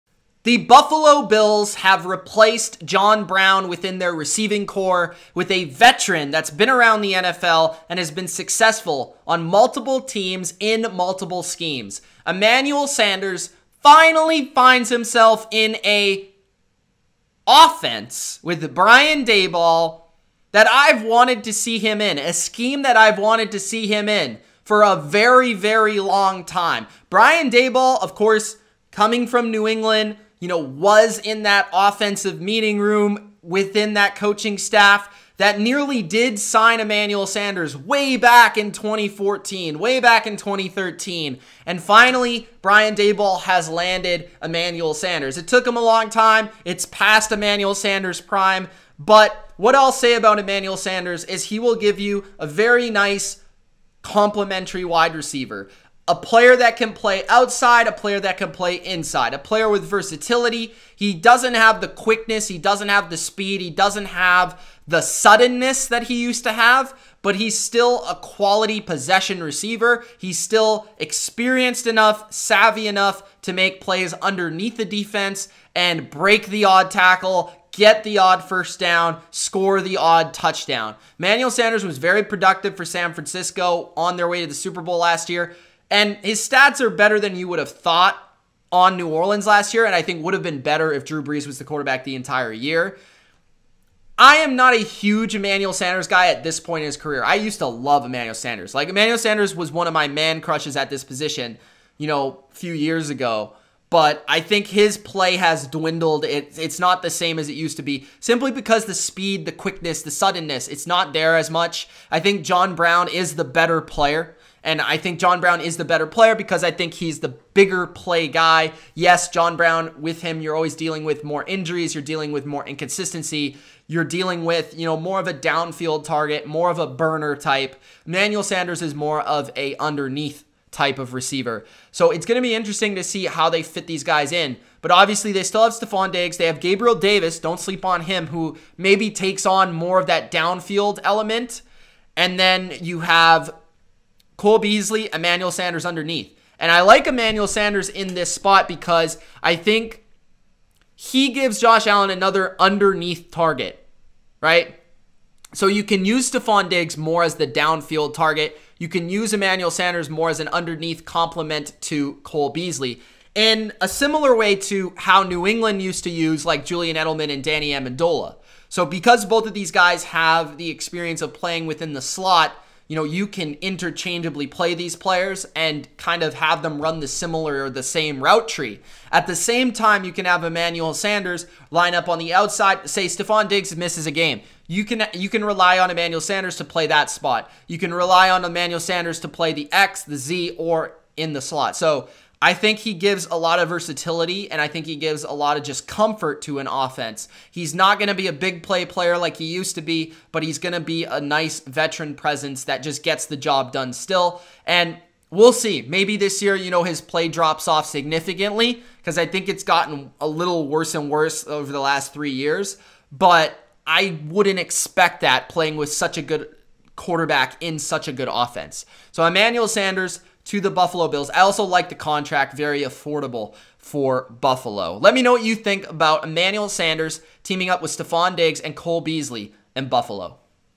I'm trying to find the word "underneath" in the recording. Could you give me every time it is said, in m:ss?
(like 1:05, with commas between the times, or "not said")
1:14, 2:09, 2:25, 2:32, 2:40.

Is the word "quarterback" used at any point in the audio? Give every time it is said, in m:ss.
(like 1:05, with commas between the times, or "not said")
1:31, 3:36.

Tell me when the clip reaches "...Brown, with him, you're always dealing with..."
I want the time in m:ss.
1:59.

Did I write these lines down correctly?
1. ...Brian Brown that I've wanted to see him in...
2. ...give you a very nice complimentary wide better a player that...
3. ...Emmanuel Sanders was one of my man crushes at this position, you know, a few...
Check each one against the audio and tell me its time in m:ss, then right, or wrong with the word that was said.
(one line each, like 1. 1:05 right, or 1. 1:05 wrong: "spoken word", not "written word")
1. 0:18 wrong: "Daboll", not "Brown"
2. 0:51 wrong: "receiver", not "better"
3. 1:38 right.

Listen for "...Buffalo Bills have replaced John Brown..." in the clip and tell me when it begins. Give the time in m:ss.
0:00.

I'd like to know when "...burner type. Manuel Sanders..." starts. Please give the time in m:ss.
2:06.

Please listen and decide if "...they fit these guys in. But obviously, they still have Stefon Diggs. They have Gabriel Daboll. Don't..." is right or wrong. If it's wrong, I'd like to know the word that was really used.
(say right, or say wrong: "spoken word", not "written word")
wrong: "Davis", not "Daboll".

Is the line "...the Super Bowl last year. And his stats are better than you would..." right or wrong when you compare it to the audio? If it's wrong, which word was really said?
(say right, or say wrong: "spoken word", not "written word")
right.